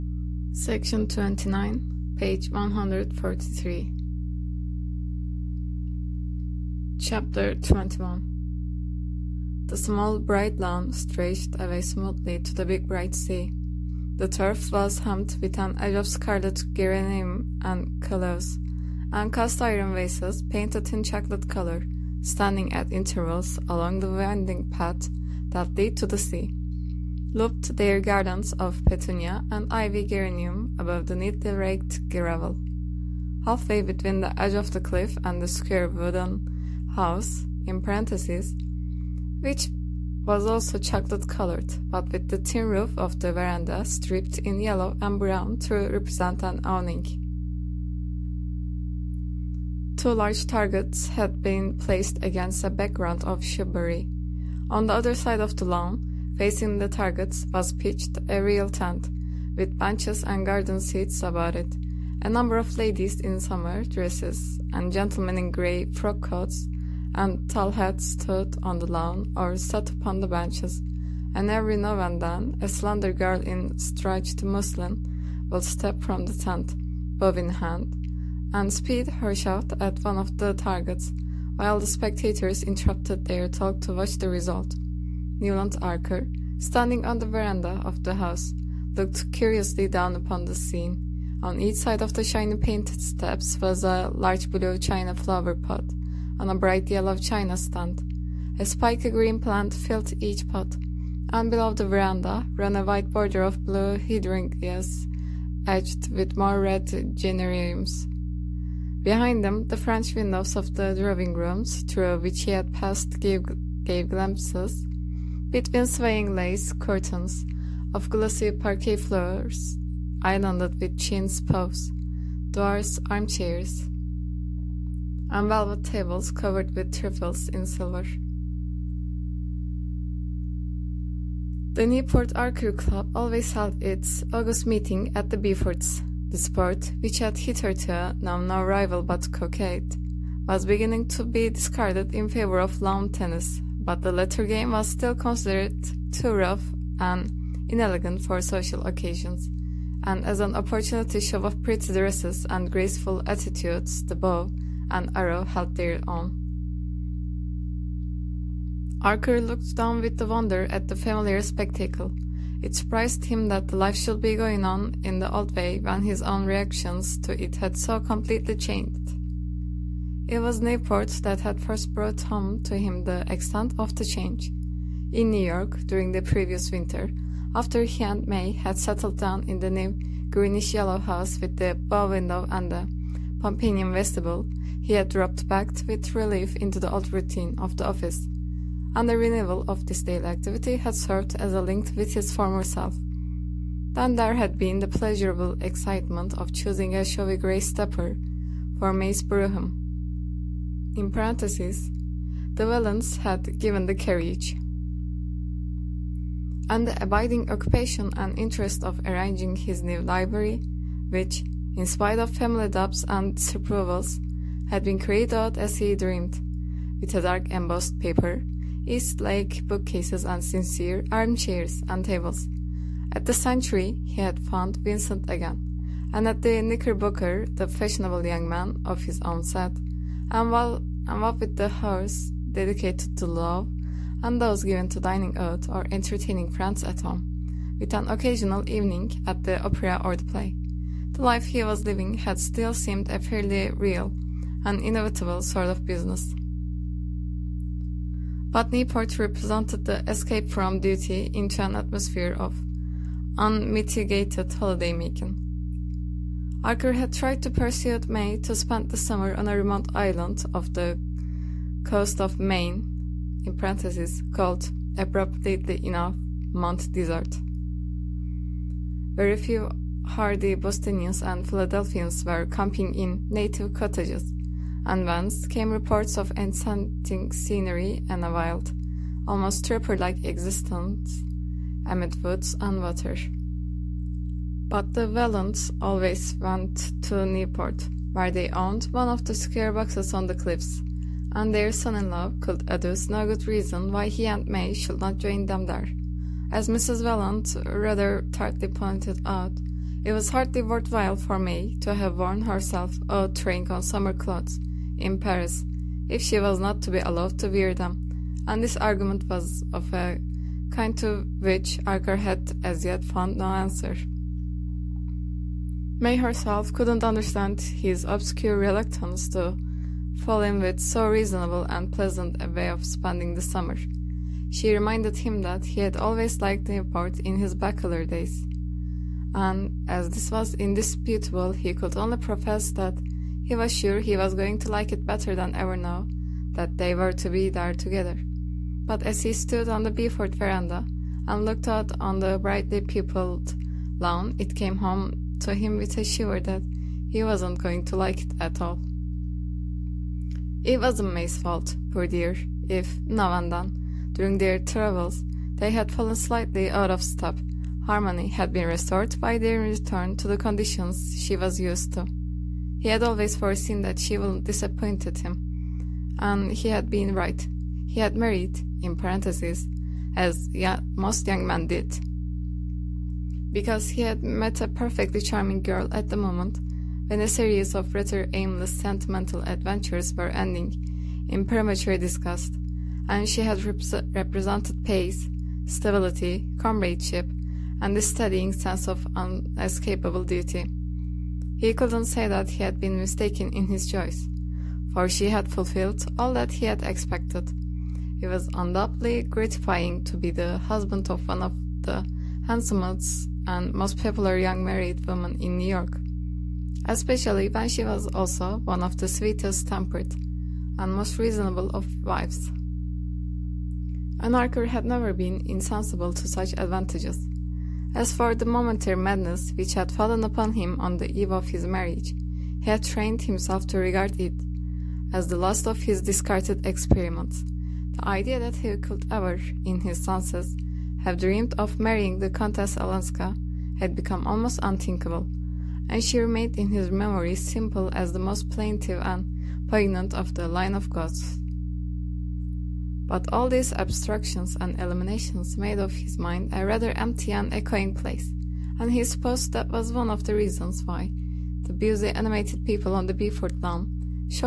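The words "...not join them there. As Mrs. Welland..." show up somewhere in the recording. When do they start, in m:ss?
4:55.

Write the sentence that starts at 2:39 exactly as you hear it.
Archer looked down with wonder at the familiar spectacle.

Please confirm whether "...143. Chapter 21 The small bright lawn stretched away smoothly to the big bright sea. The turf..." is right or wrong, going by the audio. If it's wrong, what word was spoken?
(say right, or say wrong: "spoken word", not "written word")
right.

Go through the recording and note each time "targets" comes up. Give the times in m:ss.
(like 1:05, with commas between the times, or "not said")
0:50, 0:56, 1:20.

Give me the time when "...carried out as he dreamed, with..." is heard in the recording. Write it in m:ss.
3:34.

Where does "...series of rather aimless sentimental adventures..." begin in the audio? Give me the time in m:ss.
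6:17.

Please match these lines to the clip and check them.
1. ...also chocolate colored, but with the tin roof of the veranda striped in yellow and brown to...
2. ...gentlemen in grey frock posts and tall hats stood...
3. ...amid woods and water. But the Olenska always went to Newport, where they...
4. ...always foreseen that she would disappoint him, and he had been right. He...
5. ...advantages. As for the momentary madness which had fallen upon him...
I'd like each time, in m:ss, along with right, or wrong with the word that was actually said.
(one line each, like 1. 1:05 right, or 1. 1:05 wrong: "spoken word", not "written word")
1. 0:40 right
2. 1:04 wrong: "coats", not "posts"
3. 4:41 wrong: "Wellands", not "Olenska"
4. 6:03 right
5. 6:56 right.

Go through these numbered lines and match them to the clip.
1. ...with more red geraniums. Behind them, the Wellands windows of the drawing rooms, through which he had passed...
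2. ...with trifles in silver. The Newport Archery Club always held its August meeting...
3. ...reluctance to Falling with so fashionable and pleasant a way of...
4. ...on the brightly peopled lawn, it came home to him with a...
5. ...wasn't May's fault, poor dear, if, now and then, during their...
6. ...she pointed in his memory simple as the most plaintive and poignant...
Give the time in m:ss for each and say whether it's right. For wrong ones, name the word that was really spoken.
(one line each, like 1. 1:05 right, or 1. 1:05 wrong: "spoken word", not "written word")
1. 1:46 wrong: "French", not "Wellands"
2. 2:06 right
3. 5:18 wrong: "reasonable", not "fashionable"
4. 5:41 right
5. 5:50 right
6. 7:16 wrong: "remained", not "pointed".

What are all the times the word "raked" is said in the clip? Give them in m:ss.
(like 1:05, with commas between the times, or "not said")
0:31.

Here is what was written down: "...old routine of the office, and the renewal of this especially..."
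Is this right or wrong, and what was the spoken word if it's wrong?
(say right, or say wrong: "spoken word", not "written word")
wrong: "daily", not "especially".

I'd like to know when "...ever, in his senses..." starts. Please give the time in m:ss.
7:09.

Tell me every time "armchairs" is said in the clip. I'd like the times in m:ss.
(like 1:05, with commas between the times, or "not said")
2:03, 3:41.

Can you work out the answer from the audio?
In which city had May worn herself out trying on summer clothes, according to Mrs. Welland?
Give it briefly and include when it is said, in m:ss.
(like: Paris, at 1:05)
Paris, at 5:05.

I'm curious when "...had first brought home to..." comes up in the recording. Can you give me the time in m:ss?
2:51.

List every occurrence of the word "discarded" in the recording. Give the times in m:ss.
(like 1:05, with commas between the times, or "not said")
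2:21, 7:06.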